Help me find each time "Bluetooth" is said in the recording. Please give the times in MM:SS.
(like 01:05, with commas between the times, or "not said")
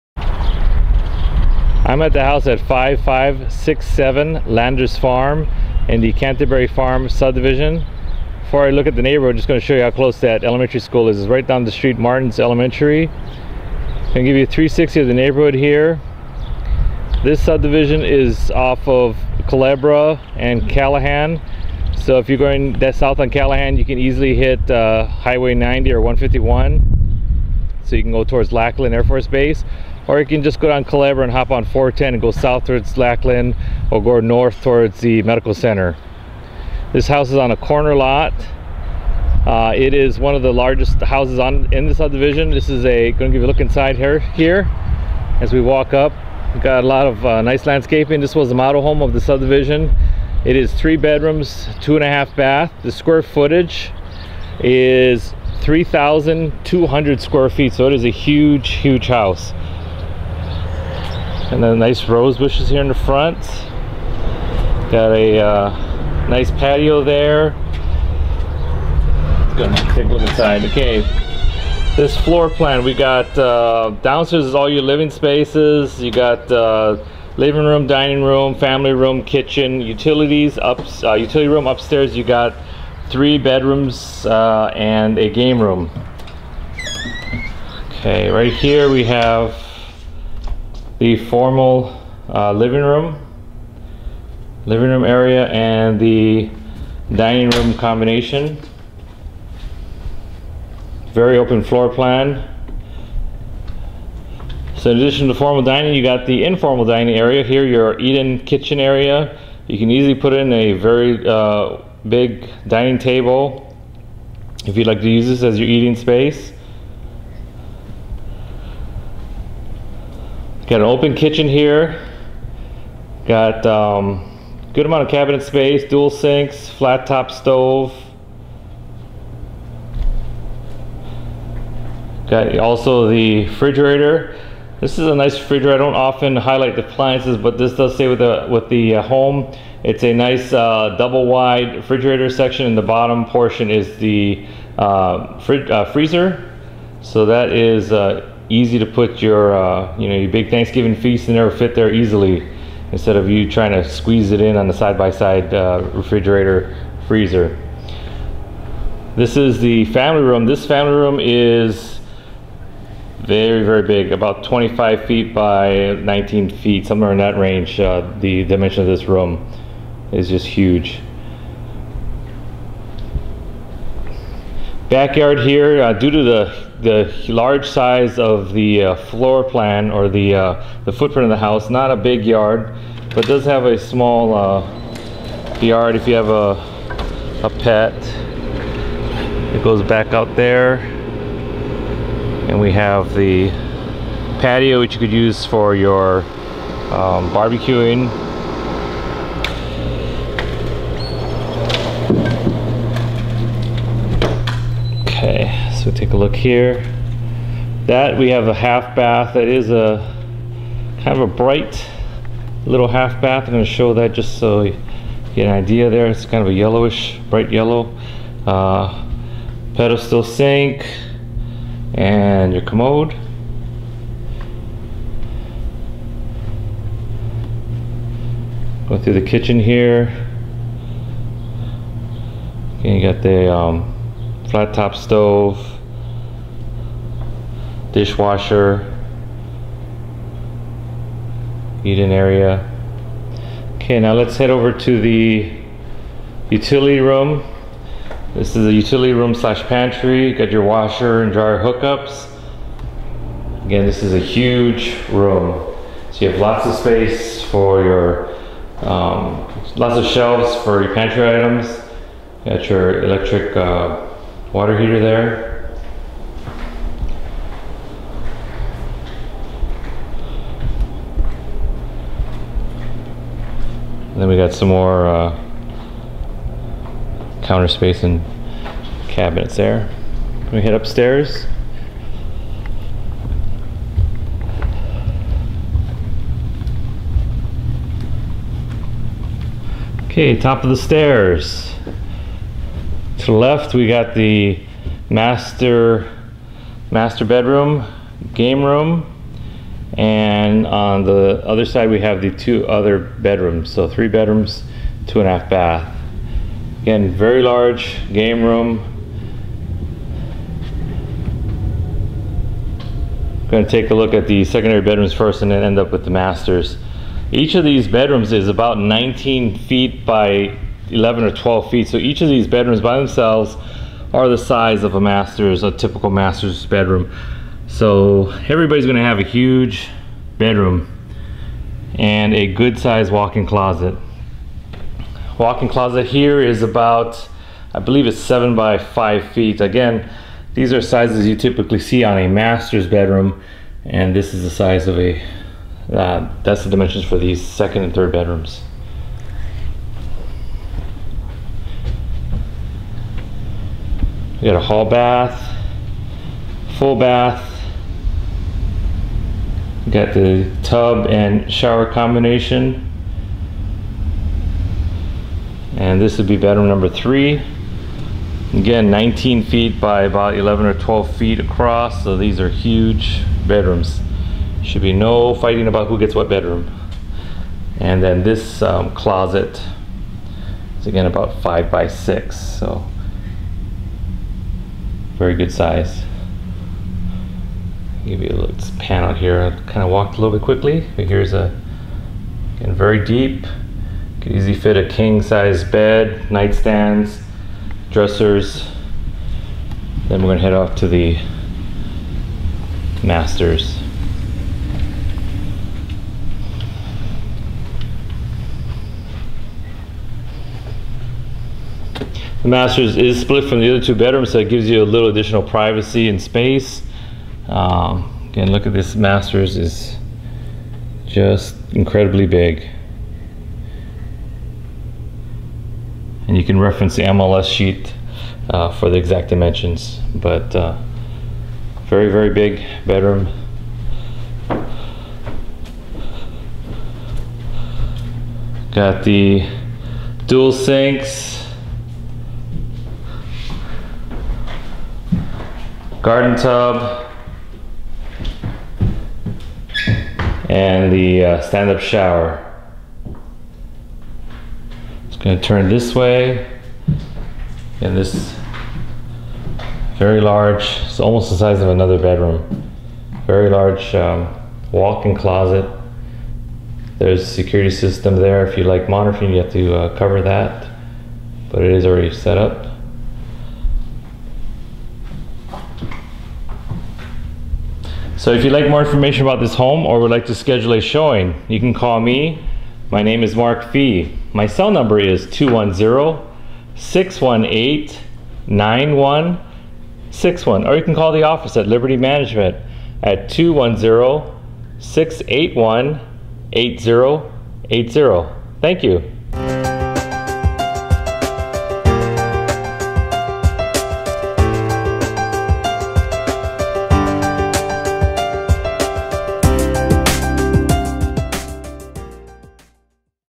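not said.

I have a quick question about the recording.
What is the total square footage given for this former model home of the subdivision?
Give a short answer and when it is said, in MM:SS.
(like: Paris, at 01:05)
3,200 square feet, at 00:55.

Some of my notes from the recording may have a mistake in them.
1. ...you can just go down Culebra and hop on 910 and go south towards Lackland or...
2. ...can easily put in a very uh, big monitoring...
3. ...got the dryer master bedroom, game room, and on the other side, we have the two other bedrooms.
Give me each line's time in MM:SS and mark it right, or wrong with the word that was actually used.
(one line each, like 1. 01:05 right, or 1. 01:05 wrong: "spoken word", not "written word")
1. 00:30 wrong: "410", not "910"
2. 01:49 wrong: "dining", not "monitoring"
3. 04:53 wrong: "master", not "dryer".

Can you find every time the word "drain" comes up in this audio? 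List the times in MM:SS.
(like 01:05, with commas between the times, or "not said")
not said.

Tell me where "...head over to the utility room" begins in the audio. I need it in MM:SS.
04:04.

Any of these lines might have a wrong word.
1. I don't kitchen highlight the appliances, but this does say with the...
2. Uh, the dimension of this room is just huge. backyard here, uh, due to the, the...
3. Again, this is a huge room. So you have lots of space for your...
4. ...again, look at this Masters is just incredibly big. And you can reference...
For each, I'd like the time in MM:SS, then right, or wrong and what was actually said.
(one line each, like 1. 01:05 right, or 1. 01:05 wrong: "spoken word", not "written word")
1. 02:15 wrong: "often", not "kitchen"
2. 02:47 right
3. 04:13 right
4. 06:58 right.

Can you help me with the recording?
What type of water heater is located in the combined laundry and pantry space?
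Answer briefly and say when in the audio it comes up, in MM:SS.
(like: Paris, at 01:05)
Electric, at 04:23.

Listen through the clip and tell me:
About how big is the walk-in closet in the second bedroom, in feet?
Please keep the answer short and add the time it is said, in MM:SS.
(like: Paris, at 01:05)
7 by 5 feet, at 05:38.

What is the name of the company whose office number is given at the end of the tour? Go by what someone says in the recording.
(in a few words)
Liberty Management.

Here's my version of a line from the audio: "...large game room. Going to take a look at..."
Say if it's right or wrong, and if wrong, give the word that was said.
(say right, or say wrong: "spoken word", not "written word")
right.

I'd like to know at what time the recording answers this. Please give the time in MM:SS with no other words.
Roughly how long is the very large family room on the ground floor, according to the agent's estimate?
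02:44.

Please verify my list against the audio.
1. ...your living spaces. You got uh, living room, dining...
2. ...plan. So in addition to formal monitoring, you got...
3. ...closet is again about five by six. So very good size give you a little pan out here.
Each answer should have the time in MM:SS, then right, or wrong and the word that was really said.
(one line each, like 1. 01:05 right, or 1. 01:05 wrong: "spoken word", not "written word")
1. 01:14 right
2. 01:41 wrong: "dining", not "monitoring"
3. 06:18 right.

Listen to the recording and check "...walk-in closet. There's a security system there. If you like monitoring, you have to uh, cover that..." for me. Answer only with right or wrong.
right.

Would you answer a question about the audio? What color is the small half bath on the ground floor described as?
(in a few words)
Bright yellow.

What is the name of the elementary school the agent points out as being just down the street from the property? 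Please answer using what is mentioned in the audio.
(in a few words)
Martin's Elementary.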